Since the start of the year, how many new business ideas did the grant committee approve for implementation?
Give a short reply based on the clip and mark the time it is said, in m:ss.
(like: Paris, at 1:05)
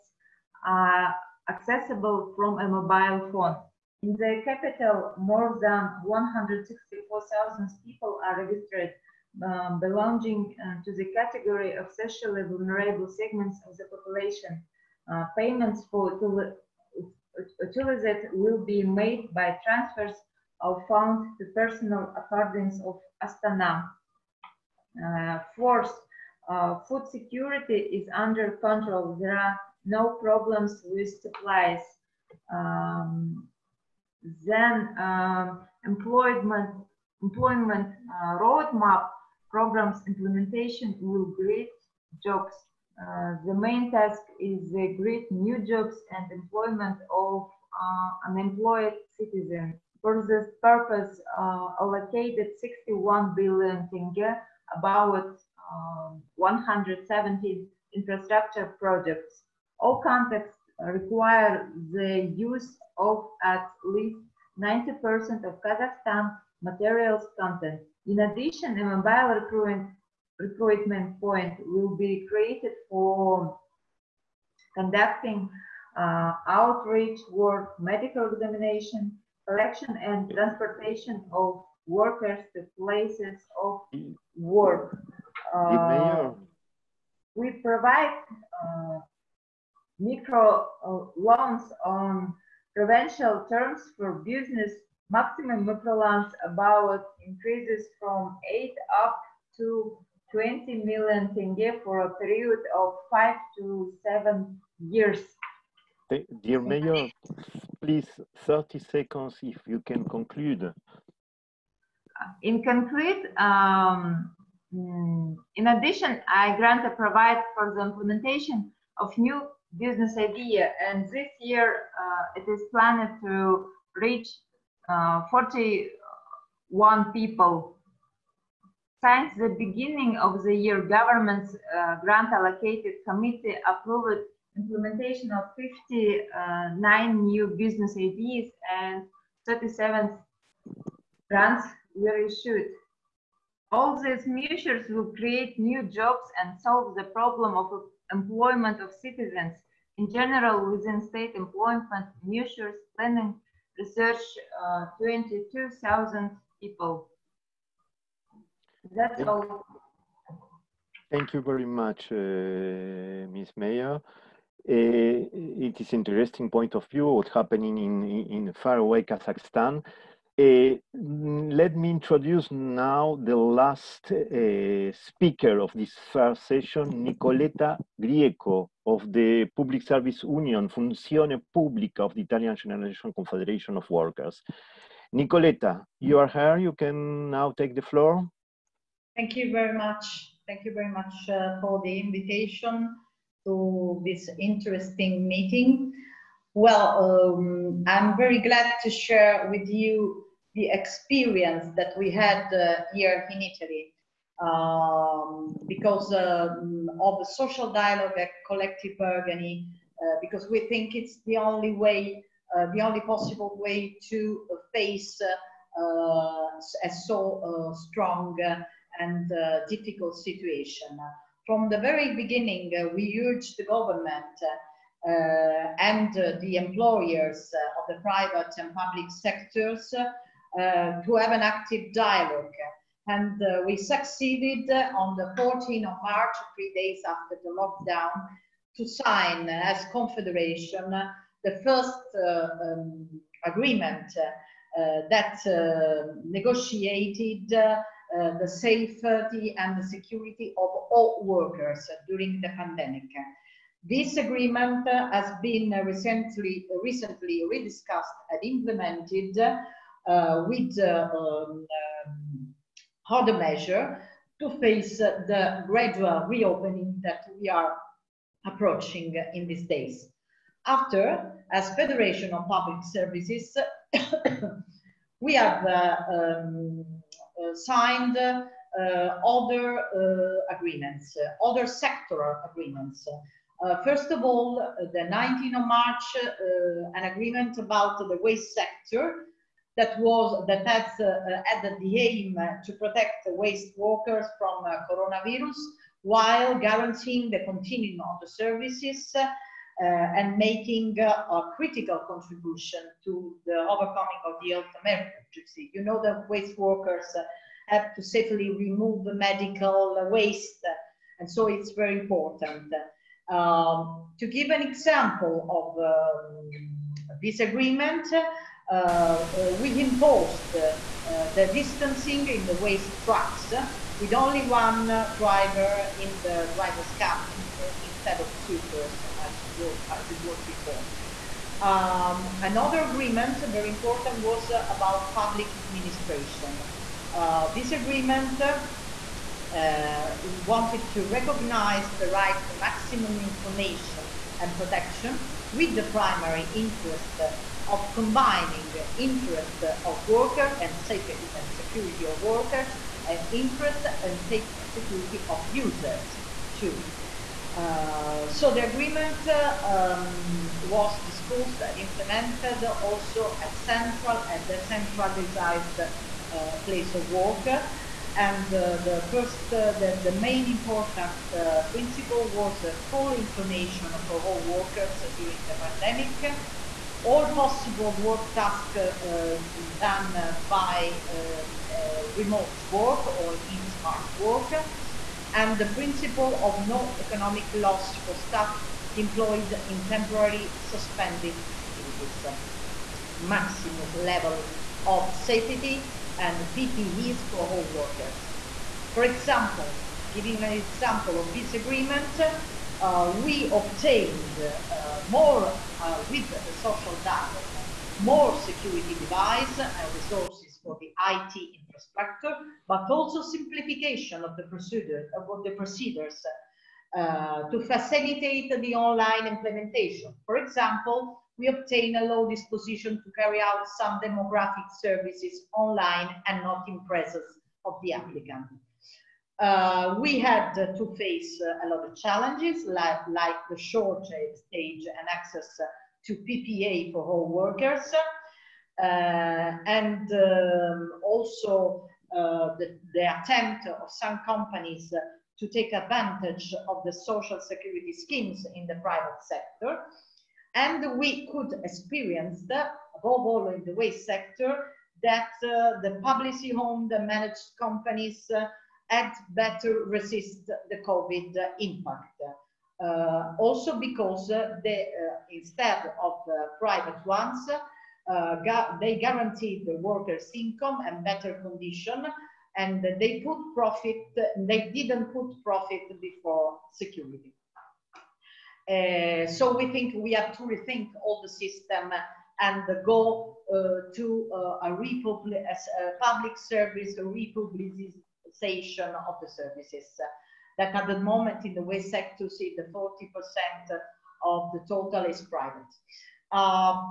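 59, at 2:15.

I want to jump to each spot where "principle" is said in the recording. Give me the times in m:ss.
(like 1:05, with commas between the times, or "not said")
6:11, 6:25.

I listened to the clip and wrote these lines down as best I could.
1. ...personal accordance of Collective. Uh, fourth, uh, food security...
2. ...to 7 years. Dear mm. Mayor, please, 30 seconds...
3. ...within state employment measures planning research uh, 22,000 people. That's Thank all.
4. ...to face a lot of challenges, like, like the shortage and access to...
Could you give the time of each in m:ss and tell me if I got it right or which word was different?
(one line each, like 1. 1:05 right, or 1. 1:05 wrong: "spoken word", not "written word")
1. 0:21 wrong: "Astana", not "Collective"
2. 1:43 right
3. 2:30 right
4. 7:10 right.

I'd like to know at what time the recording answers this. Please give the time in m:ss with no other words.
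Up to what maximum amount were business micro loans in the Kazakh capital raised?
1:40.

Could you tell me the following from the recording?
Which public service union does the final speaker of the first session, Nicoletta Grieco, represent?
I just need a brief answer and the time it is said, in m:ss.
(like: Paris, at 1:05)
Funzione Pubblica, at 3:00.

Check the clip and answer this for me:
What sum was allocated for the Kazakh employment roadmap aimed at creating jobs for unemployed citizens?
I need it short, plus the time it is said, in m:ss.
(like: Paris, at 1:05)
61 billion tenge, at 0:52.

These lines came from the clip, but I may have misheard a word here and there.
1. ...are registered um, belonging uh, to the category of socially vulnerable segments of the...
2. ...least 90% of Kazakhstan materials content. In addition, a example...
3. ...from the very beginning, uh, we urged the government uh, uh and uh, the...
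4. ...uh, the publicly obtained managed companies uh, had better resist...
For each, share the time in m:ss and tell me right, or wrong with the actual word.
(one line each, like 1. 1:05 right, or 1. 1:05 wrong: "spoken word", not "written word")
1. 0:08 right
2. 1:03 wrong: "mobile", not "example"
3. 3:41 right
4. 7:35 wrong: "owned", not "obtained".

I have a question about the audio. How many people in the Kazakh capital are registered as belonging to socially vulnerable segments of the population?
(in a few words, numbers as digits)
more than 164,000.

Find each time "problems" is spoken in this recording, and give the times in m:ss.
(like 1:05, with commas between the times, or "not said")
0:30, 2:27.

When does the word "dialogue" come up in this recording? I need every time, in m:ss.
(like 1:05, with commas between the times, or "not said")
3:27, 3:51, 6:47.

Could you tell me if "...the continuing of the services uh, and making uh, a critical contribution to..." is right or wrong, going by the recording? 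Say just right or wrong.
right.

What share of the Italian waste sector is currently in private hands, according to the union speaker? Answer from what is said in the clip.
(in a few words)
40%.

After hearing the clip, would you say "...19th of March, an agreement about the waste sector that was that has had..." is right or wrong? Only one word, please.
right.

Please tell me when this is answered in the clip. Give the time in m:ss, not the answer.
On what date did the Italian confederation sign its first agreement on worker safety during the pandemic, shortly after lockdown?
3:55.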